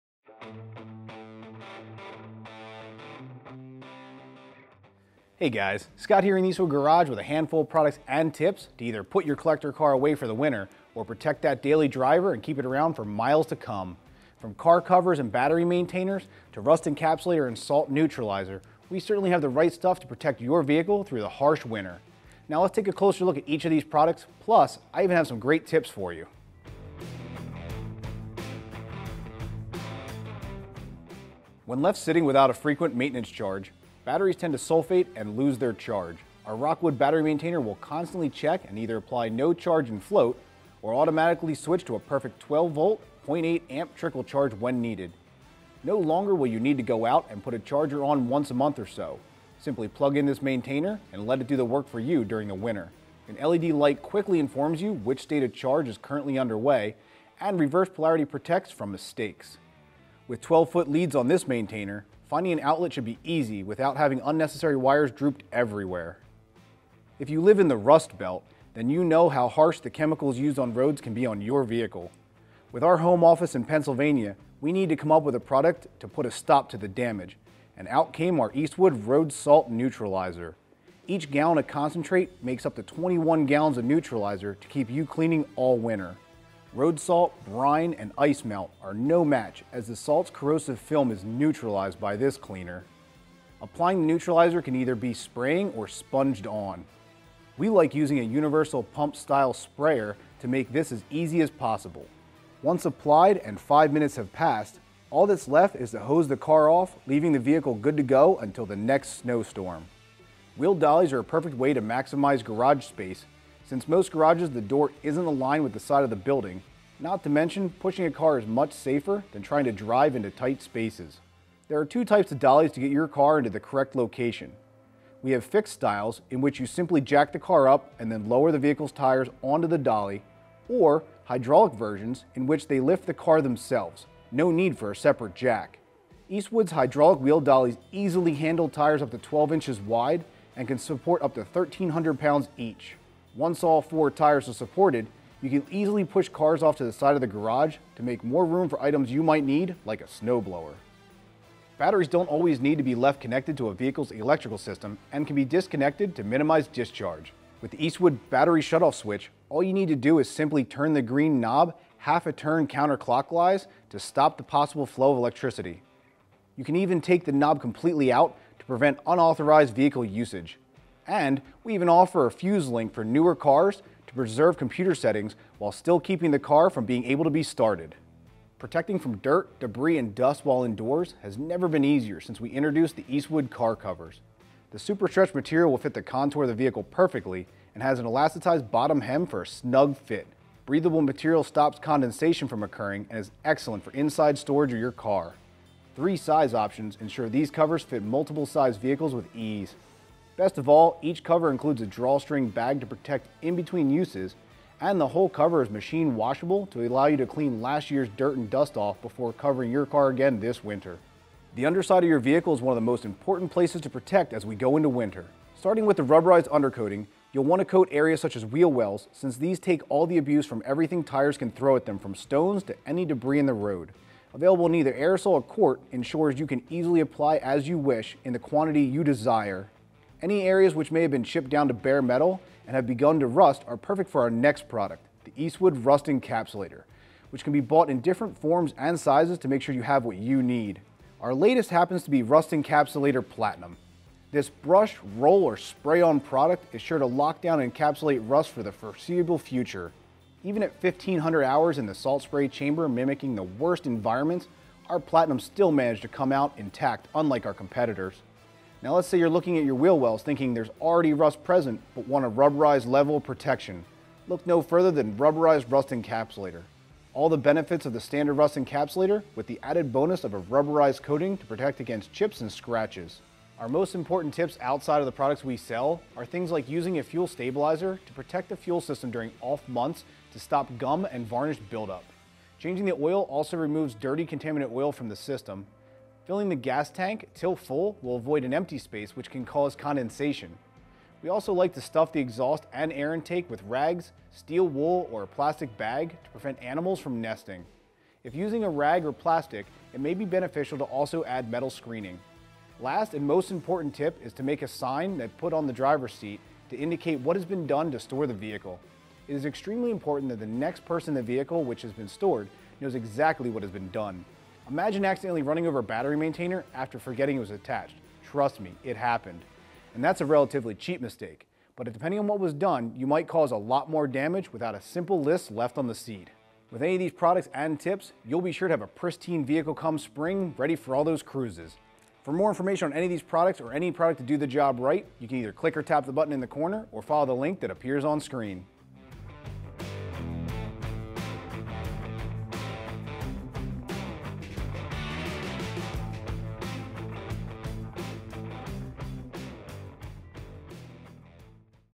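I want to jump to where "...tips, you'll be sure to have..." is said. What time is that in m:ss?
5:27.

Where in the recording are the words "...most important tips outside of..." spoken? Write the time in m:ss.
4:33.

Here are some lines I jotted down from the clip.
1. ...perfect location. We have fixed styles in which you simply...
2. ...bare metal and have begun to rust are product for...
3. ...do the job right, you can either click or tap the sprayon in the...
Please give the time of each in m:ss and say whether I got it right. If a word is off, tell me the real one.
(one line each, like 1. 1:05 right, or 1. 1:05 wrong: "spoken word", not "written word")
1. 2:03 wrong: "correct", not "perfect"
2. 3:51 wrong: "perfect", not "product"
3. 5:34 wrong: "button", not "sprayon".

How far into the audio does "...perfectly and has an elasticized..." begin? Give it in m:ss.
3:06.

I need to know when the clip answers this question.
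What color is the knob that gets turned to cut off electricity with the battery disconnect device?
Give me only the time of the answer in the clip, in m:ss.
2:41.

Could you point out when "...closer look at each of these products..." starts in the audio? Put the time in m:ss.
0:22.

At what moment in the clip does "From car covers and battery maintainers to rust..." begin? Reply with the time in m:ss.
0:14.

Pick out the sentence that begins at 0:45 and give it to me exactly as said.
No longer will you need to go out and put a charger on once a month or so.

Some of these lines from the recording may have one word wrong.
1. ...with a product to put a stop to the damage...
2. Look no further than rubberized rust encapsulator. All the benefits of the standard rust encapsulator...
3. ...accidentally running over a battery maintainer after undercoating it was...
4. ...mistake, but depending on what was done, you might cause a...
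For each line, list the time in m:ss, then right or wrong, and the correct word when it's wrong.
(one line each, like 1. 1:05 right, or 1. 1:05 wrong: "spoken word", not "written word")
1. 1:15 right
2. 4:24 right
3. 5:15 wrong: "forgetting", not "undercoating"
4. 5:21 right.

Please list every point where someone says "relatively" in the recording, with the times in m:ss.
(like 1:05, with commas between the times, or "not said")
5:20.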